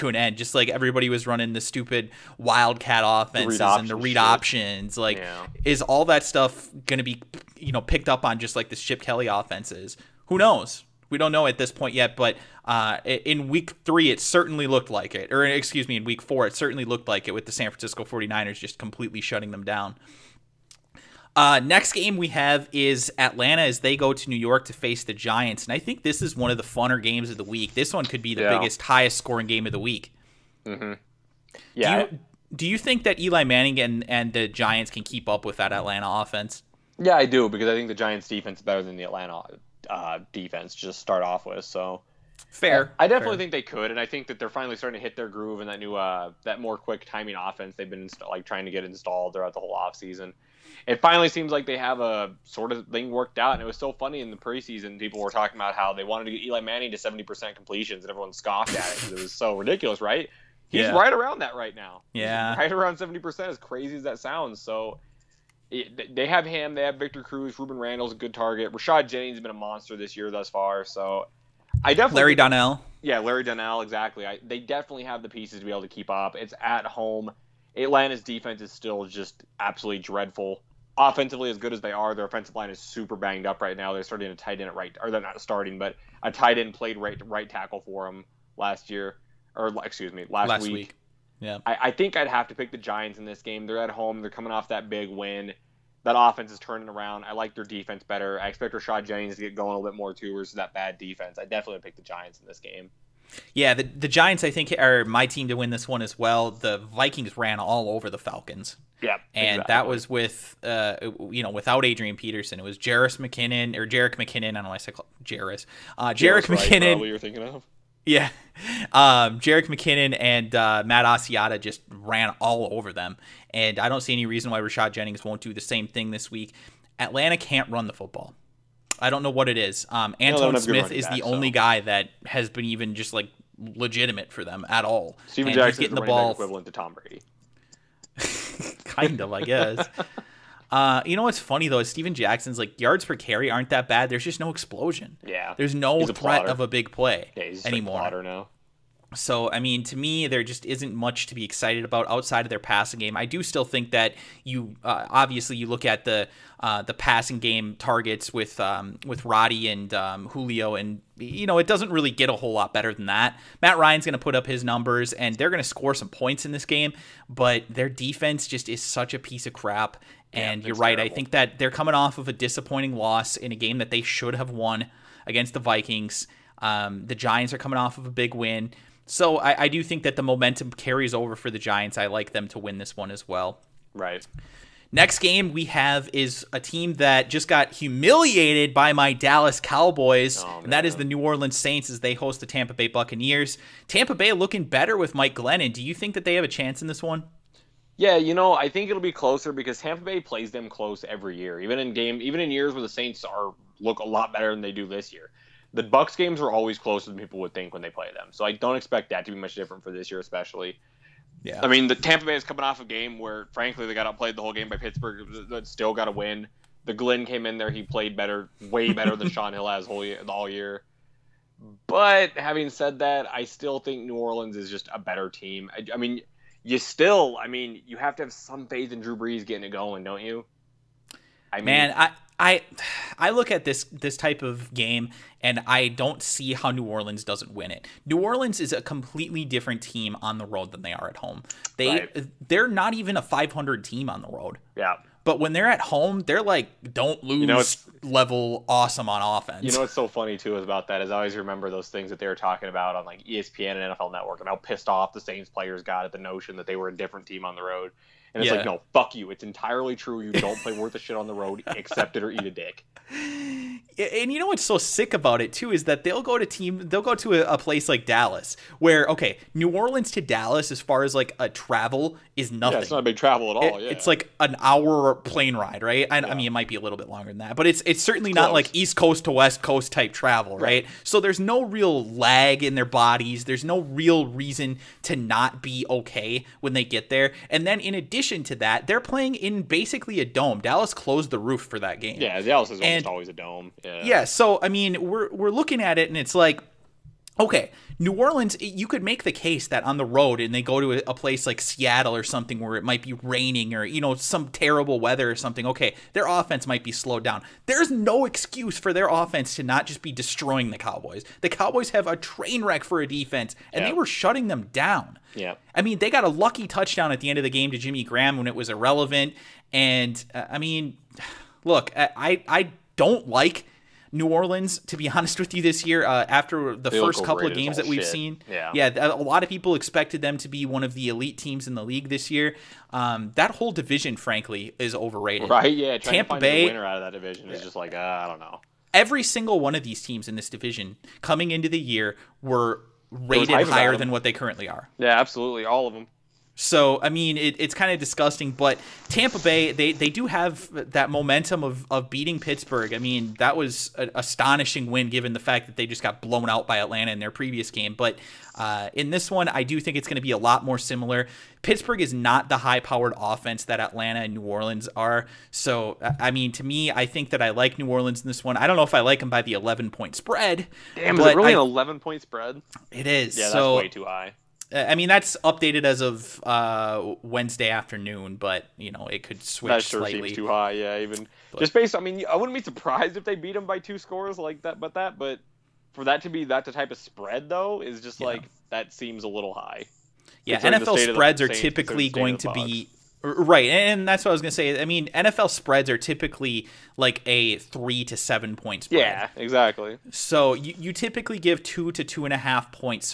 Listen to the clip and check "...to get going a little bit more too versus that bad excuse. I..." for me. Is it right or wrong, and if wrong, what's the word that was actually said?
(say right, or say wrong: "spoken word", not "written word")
wrong: "defense", not "excuse".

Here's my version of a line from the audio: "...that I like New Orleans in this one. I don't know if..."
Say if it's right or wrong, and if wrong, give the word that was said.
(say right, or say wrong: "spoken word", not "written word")
right.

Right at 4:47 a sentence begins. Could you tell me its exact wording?
And then in addition addition to that, they're playing in basically a dome.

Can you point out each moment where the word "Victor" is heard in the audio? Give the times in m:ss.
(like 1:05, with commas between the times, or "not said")
1:06.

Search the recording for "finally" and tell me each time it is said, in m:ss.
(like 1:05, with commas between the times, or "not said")
0:44, 0:51.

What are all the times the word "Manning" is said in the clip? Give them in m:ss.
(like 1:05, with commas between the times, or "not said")
0:33, 0:56.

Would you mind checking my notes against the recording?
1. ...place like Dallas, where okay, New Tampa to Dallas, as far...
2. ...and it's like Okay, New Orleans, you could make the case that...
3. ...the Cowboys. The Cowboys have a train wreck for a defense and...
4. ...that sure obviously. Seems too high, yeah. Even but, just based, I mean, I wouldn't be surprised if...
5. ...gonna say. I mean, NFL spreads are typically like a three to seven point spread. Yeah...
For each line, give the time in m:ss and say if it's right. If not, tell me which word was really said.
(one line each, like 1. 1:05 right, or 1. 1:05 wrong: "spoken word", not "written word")
1. 4:27 wrong: "Orleans", not "Tampa"
2. 4:56 right
3. 5:10 right
4. 6:19 wrong: "slightly", not "obviously"
5. 6:34 right.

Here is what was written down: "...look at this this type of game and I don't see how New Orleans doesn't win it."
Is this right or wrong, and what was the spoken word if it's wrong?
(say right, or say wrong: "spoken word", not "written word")
right.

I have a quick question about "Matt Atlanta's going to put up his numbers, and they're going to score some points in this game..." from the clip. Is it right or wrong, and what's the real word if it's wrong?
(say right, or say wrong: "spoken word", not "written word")
wrong: "Ryan", not "Atlanta".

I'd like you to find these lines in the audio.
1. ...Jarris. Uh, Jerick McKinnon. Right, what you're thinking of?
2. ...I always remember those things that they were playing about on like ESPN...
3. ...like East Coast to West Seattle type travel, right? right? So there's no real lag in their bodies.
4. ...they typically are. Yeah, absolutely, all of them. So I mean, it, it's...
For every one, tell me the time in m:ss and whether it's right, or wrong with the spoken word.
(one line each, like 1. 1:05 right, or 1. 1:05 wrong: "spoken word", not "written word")
1. 1:55 right
2. 4:11 wrong: "talking", not "playing"
3. 4:38 wrong: "Coast", not "Seattle"
4. 5:44 wrong: "currently", not "typically".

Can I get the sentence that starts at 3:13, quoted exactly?
Tampa Bay looking better with Mike Glennon.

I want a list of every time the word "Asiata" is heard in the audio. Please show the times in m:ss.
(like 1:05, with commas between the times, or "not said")
2:01.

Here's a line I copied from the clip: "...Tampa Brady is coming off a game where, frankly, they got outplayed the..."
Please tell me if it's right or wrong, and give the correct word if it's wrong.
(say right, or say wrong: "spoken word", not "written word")
wrong: "Bay", not "Brady".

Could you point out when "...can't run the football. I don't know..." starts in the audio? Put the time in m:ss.
2:07.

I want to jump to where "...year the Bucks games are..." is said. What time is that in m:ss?
3:25.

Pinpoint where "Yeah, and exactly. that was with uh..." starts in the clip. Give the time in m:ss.
1:49.